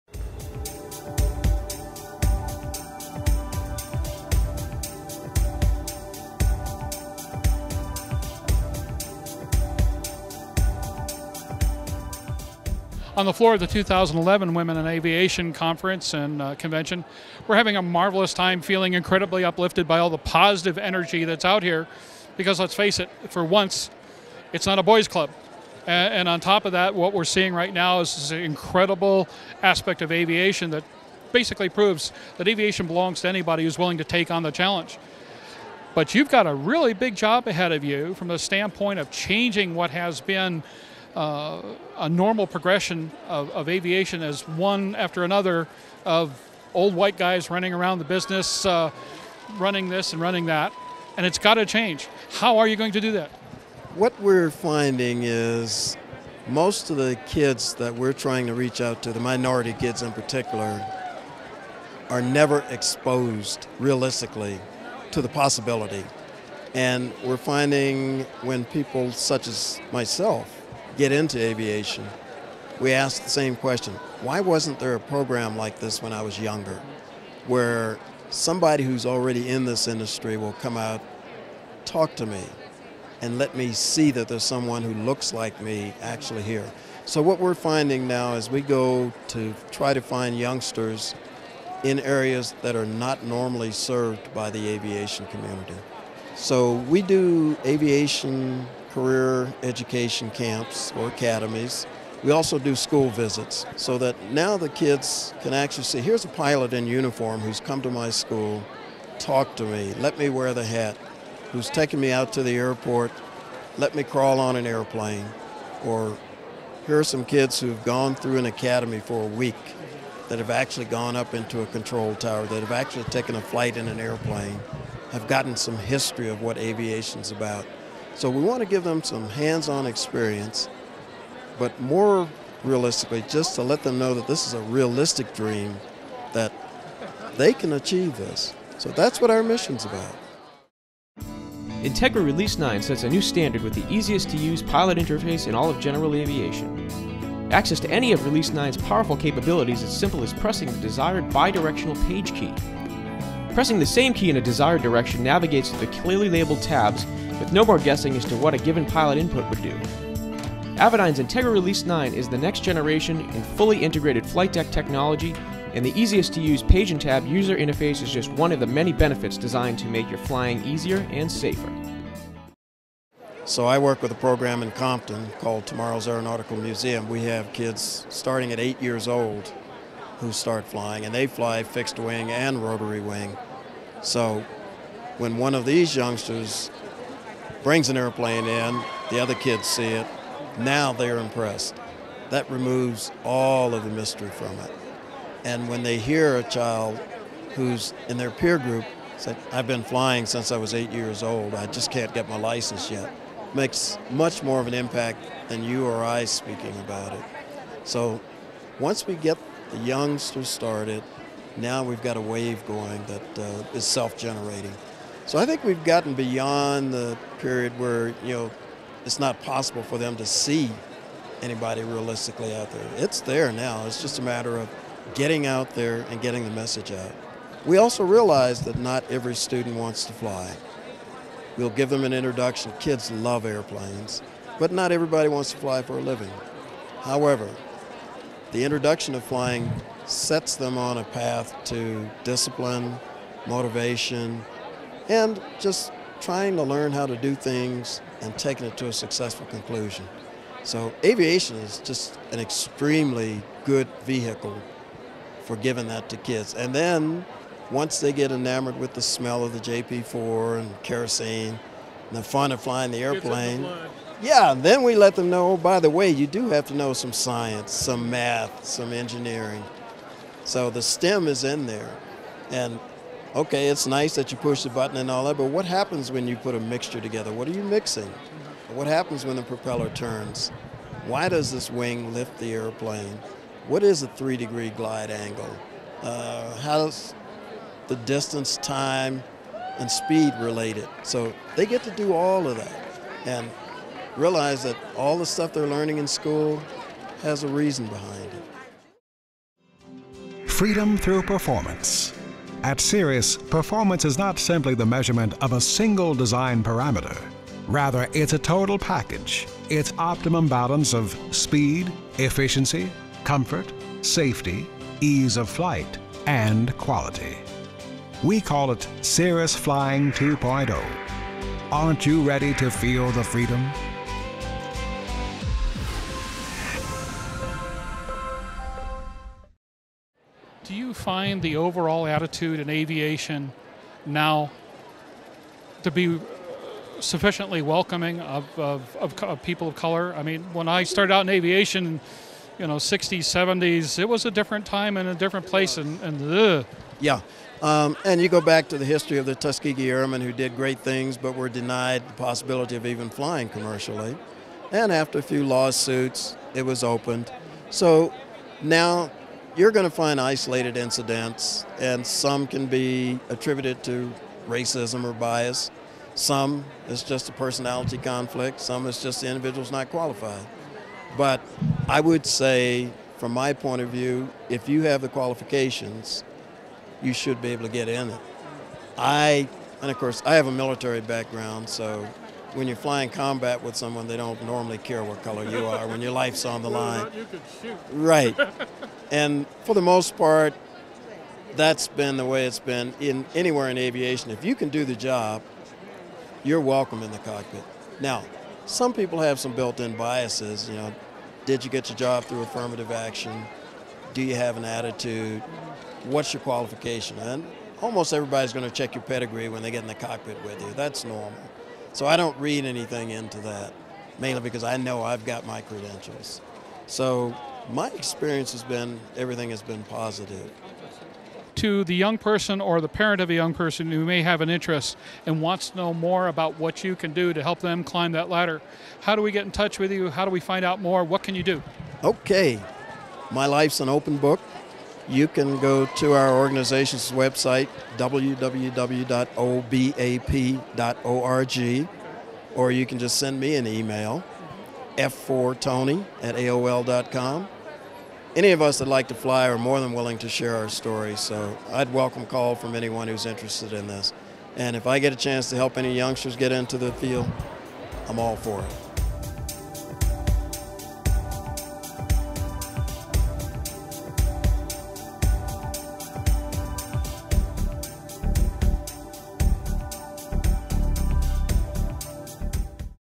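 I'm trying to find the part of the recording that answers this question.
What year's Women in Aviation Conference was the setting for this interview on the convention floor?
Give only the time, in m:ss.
0:13.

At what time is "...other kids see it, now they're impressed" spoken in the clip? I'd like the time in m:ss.
3:09.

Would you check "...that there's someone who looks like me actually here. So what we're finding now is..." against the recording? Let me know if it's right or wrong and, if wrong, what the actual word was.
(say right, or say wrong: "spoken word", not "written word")
right.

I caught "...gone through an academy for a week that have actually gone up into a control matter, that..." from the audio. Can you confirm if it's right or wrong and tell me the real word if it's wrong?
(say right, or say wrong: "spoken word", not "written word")
wrong: "tower", not "matter".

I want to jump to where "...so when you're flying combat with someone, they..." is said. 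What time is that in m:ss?
6:21.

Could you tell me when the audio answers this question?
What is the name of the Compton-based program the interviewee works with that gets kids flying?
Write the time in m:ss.
2:55.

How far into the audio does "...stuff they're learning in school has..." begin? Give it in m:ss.
4:55.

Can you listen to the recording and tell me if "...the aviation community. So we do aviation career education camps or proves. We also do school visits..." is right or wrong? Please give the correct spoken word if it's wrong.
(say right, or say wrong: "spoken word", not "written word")
wrong: "academies", not "proves".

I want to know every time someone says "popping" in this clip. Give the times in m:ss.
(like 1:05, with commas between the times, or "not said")
not said.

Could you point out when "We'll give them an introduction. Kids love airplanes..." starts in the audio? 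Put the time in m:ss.
3:51.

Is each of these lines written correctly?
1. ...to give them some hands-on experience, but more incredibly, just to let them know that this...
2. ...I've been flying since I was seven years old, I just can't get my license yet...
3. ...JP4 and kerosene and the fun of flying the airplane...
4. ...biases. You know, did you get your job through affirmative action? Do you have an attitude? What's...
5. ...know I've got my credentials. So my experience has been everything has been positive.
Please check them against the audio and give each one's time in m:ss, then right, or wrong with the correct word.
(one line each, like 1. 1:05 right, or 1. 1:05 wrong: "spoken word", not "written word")
1. 2:08 wrong: "realistically", not "incredibly"
2. 3:19 wrong: "eight", not "seven"
3. 4:19 right
4. 6:39 right
5. 6:54 right.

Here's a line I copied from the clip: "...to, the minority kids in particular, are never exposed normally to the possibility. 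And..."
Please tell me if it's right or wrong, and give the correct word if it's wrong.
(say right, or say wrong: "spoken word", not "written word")
wrong: "realistically", not "normally".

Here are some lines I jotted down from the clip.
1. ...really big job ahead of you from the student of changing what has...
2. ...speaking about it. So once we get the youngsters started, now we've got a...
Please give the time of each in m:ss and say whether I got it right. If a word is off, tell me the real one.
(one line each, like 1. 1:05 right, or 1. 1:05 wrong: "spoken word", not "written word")
1. 0:36 wrong: "standpoint", not "student"
2. 3:26 right.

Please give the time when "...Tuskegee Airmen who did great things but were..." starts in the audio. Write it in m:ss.
5:49.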